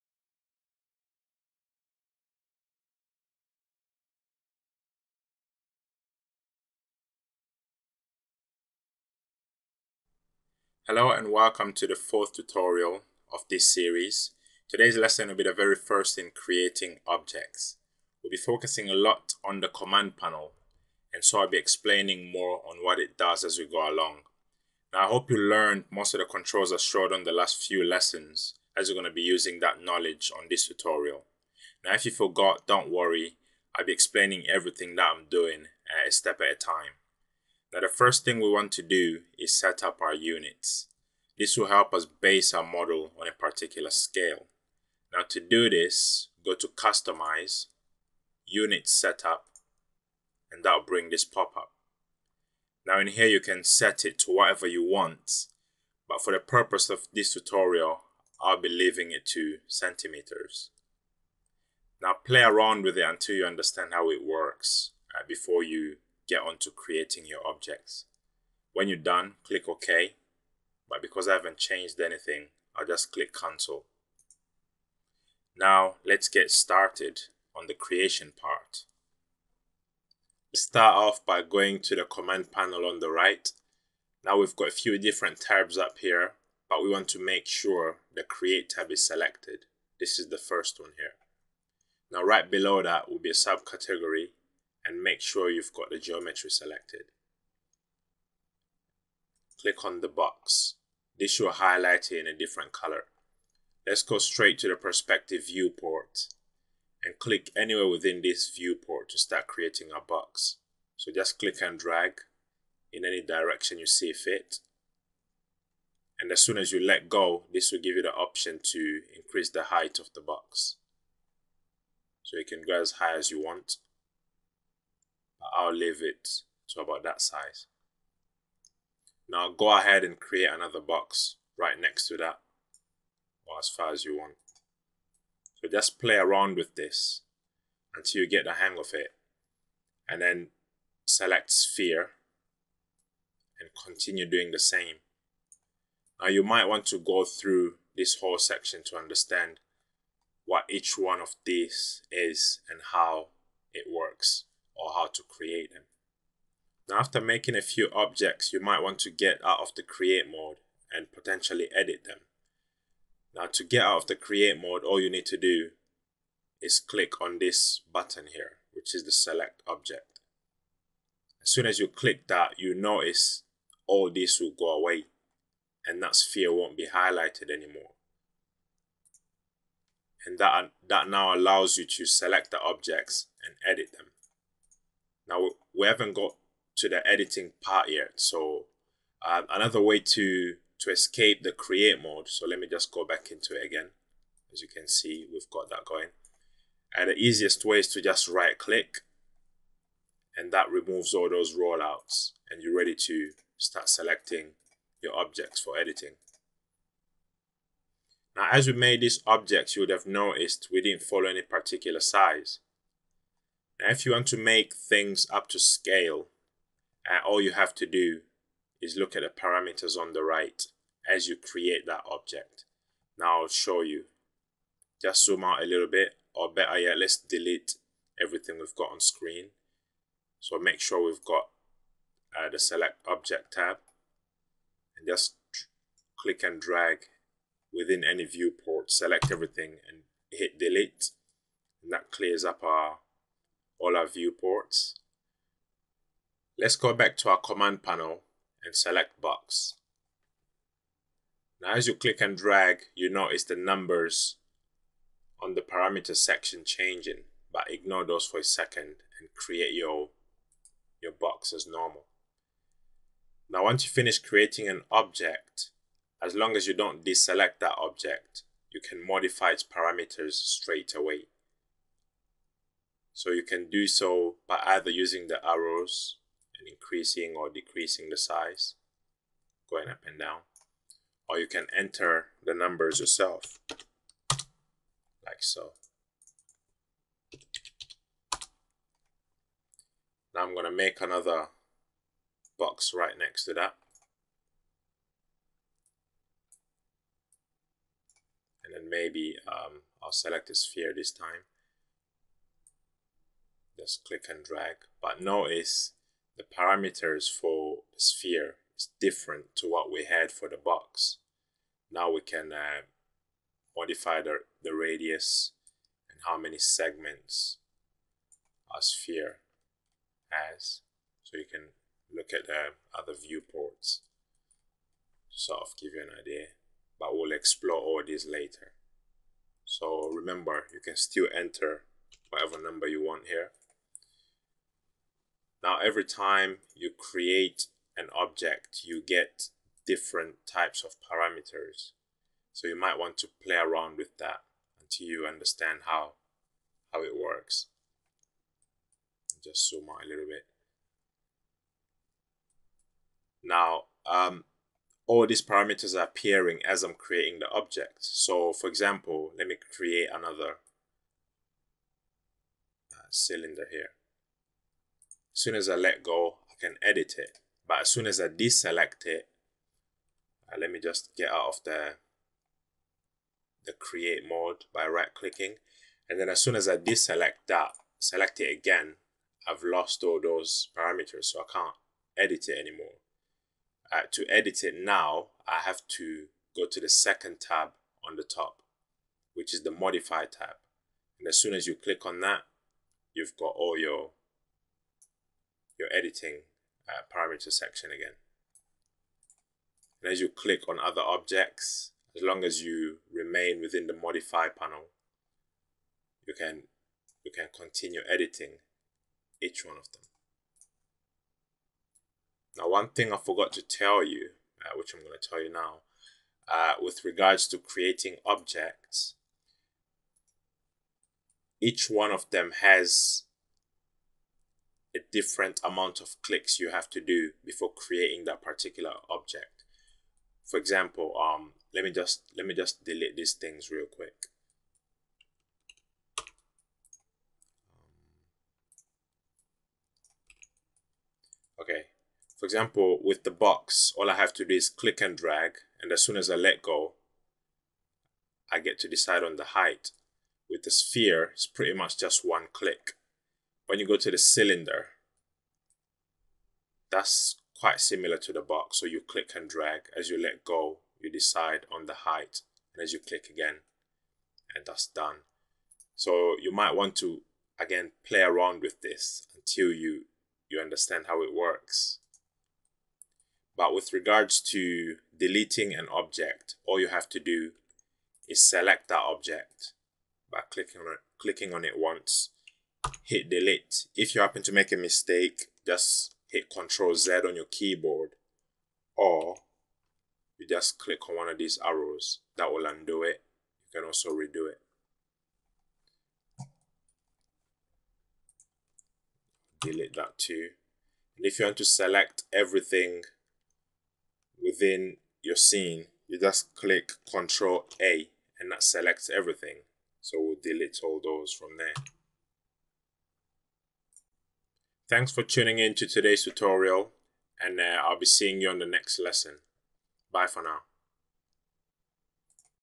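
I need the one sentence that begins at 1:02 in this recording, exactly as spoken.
Now play around with it until you understand how it works uh, before you get on to creating your objects.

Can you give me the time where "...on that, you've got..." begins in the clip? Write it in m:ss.
6:32.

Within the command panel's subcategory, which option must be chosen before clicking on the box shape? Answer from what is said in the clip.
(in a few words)
geometry.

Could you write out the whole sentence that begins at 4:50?
Now I'm going to make another box right next to that.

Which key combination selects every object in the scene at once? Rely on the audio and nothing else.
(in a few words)
Control A.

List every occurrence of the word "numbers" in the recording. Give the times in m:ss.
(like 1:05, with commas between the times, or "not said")
4:13, 4:42, 5:32.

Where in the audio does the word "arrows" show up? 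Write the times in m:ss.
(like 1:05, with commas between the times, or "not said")
4:35, 8:11.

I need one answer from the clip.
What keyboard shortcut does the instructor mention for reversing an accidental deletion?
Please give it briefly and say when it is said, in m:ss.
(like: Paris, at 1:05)
Control Z, at 8:06.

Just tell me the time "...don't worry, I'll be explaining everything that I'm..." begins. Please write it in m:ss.
0:32.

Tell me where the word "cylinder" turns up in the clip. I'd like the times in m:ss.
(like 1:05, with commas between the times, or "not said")
6:03, 7:34.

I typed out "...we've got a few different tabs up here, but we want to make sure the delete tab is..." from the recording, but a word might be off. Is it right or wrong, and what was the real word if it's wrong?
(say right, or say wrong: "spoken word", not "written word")
wrong: "create", not "delete".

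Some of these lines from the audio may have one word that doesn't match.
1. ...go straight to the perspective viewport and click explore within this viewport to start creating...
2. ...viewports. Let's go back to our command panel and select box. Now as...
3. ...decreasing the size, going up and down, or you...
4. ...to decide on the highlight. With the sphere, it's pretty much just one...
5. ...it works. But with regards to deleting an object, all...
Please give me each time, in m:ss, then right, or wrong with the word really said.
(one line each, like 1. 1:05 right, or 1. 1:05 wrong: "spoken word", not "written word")
1. 1:44 wrong: "anywhere", not "explore"
2. 4:04 right
3. 4:37 right
4. 7:28 wrong: "height", not "highlight"
5. 7:51 right.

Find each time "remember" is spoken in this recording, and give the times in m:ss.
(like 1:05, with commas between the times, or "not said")
5:30.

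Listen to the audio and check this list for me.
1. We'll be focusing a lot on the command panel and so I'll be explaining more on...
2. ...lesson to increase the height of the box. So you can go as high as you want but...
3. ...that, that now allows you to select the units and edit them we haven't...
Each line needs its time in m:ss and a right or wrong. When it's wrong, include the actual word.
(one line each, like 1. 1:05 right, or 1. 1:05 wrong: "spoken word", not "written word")
1. 0:18 right
2. 1:58 wrong: "option", not "lesson"
3. 3:00 wrong: "objects", not "units".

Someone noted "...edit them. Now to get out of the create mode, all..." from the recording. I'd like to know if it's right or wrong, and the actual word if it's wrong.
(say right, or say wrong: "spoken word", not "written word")
right.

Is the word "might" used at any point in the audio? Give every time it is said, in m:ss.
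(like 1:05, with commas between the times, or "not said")
2:26, 2:38, 5:42, 7:46.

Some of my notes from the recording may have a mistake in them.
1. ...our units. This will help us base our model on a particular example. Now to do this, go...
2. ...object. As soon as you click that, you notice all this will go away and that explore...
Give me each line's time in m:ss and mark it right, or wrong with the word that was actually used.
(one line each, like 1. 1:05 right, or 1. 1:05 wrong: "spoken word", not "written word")
1. 0:40 wrong: "scale", not "example"
2. 2:49 wrong: "sphere", not "explore".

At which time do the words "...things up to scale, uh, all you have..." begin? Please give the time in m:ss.
3:34.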